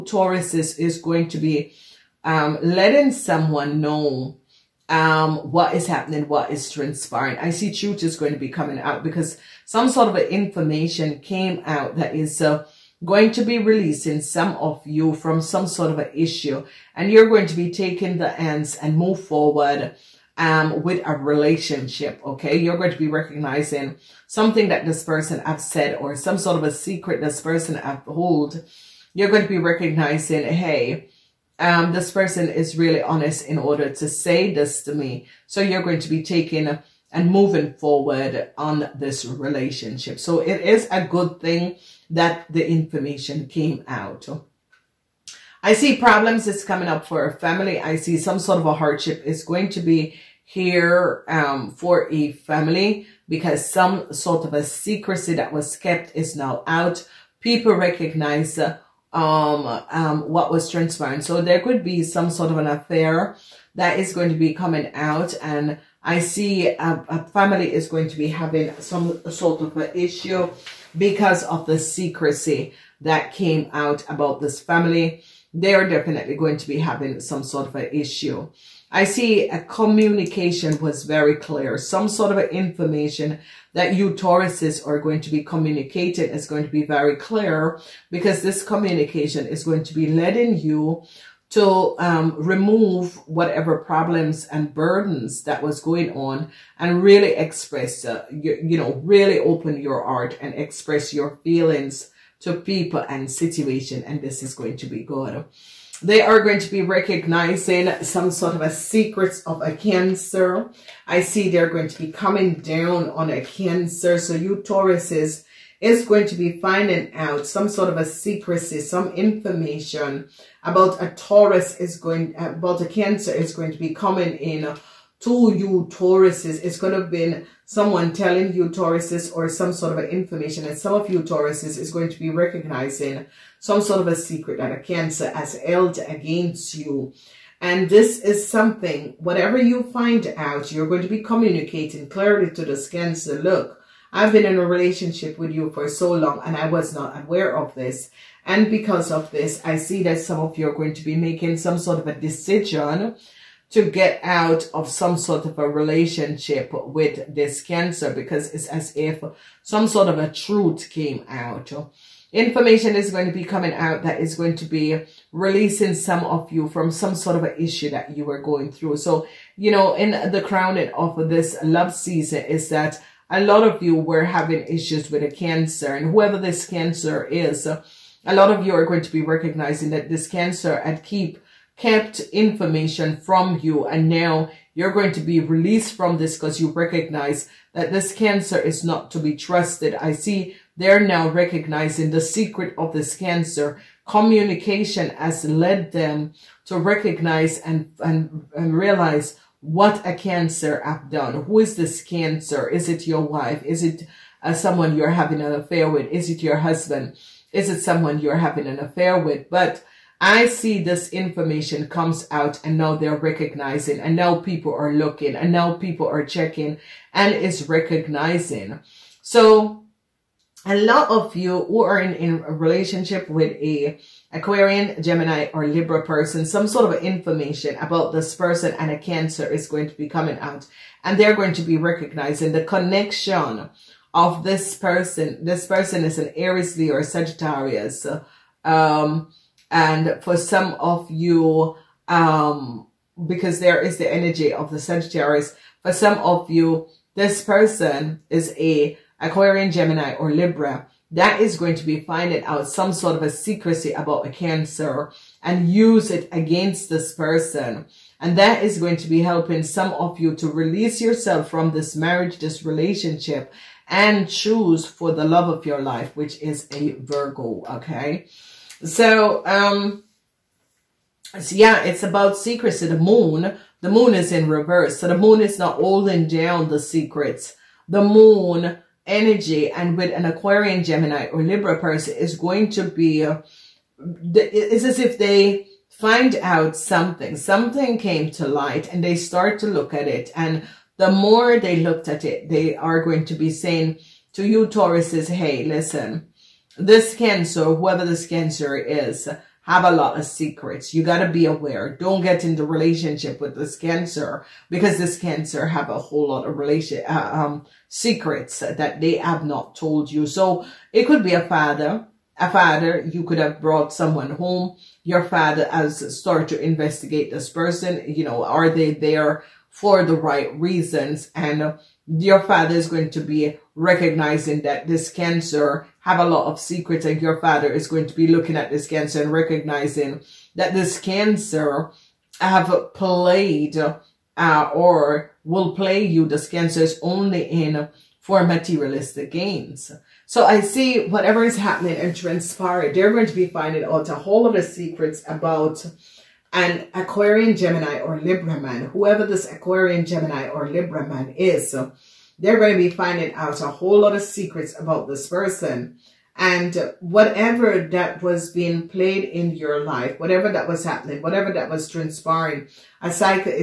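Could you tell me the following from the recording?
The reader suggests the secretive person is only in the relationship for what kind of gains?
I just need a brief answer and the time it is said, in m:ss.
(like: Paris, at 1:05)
Materialistic gains, at 5:38.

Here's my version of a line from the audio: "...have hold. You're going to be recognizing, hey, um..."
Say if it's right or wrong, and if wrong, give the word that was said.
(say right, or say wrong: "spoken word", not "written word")
right.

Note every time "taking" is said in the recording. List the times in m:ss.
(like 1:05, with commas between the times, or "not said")
0:17, 0:36.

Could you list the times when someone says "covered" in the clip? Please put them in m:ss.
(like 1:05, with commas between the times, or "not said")
not said.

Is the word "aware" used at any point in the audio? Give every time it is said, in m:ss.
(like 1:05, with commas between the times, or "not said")
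2:27, 5:01.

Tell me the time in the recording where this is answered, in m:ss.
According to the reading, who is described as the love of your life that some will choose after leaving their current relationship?
4:26.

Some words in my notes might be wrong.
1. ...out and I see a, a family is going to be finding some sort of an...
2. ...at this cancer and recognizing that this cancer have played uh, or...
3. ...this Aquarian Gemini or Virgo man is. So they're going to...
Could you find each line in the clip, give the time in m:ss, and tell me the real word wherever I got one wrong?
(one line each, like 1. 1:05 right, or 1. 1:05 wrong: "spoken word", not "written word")
1. 1:04 wrong: "having", not "finding"
2. 5:28 right
3. 5:49 wrong: "Libra", not "Virgo".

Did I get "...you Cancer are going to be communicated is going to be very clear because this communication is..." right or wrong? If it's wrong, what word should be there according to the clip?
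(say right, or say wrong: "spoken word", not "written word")
wrong: "Tauruses", not "Cancer".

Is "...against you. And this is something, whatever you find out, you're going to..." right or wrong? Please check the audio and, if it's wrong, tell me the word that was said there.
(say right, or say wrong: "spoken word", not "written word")
right.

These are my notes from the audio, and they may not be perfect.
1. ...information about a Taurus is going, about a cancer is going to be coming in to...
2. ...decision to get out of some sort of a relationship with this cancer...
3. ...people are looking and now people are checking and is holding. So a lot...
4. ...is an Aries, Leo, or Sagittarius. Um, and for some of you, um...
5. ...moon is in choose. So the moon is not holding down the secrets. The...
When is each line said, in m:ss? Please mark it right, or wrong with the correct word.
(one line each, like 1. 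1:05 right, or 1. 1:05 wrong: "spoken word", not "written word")
1. 1:59 right
2. 2:32 right
3. 3:34 wrong: "recognizing", not "holding"
4. 3:56 right
5. 4:33 wrong: "reverse", not "choose".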